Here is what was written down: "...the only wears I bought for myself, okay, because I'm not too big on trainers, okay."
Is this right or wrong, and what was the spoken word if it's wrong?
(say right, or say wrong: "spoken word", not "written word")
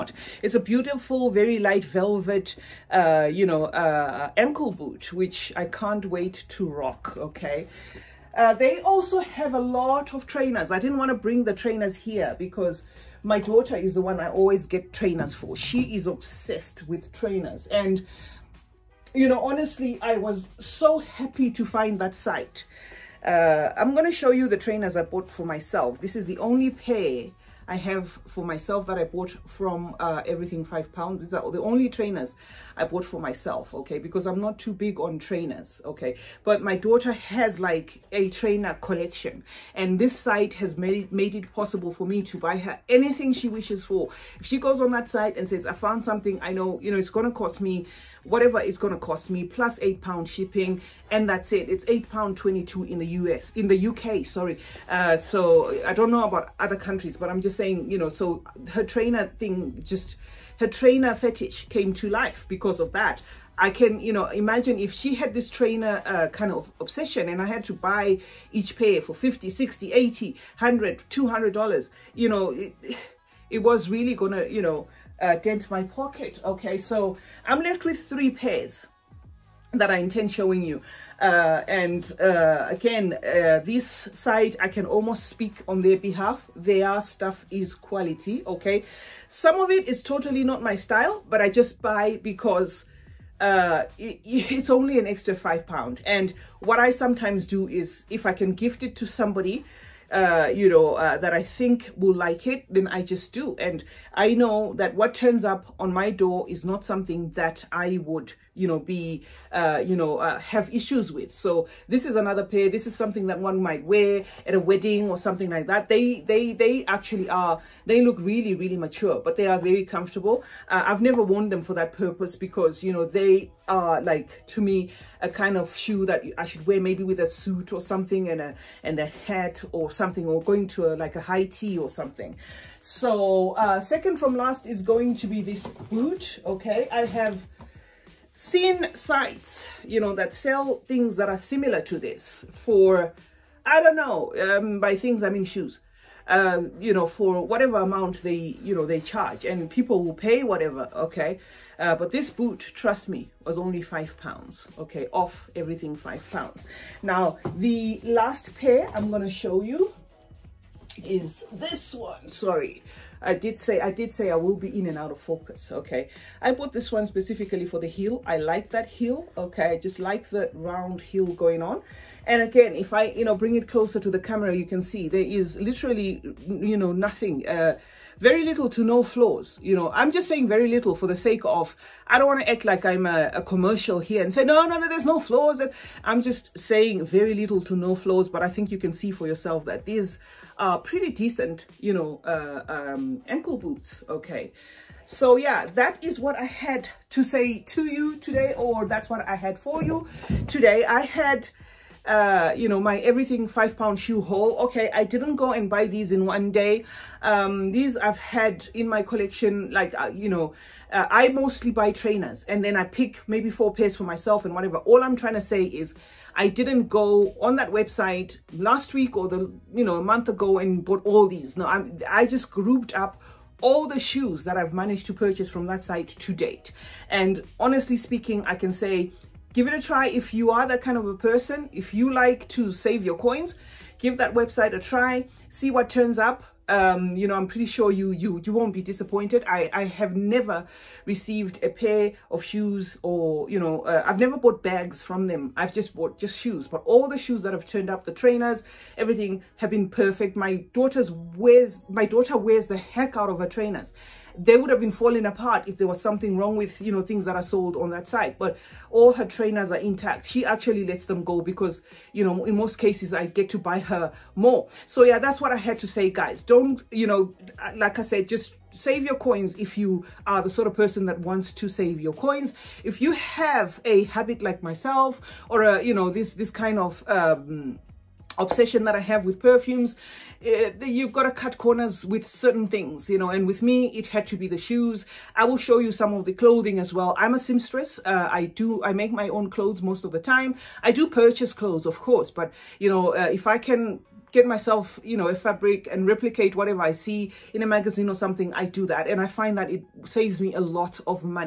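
wrong: "trainers", not "wears".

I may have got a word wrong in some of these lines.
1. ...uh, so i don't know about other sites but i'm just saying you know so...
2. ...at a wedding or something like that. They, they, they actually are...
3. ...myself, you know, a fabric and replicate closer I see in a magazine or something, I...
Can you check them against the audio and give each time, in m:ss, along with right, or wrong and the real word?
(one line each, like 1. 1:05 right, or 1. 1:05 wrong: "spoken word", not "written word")
1. 0:54 wrong: "countries", not "sites"
2. 1:54 right
3. 4:54 wrong: "whatever", not "closer".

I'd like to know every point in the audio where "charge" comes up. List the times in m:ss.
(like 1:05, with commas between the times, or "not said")
2:29.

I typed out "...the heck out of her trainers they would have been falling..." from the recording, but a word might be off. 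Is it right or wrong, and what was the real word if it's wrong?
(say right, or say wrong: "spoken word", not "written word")
right.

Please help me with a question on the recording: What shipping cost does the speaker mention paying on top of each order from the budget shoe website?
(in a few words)
8 pounds.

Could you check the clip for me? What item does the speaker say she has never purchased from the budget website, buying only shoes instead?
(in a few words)
Bags.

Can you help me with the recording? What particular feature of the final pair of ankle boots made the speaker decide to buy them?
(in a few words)
The round heel.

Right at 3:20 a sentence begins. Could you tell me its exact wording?
I had uh, you know, my everything five pound shoe haul.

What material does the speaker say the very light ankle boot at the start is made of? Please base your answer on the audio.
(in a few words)
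Velvet.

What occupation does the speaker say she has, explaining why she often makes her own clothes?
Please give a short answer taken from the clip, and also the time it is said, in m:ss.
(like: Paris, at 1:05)
Seamstress, at 4:47.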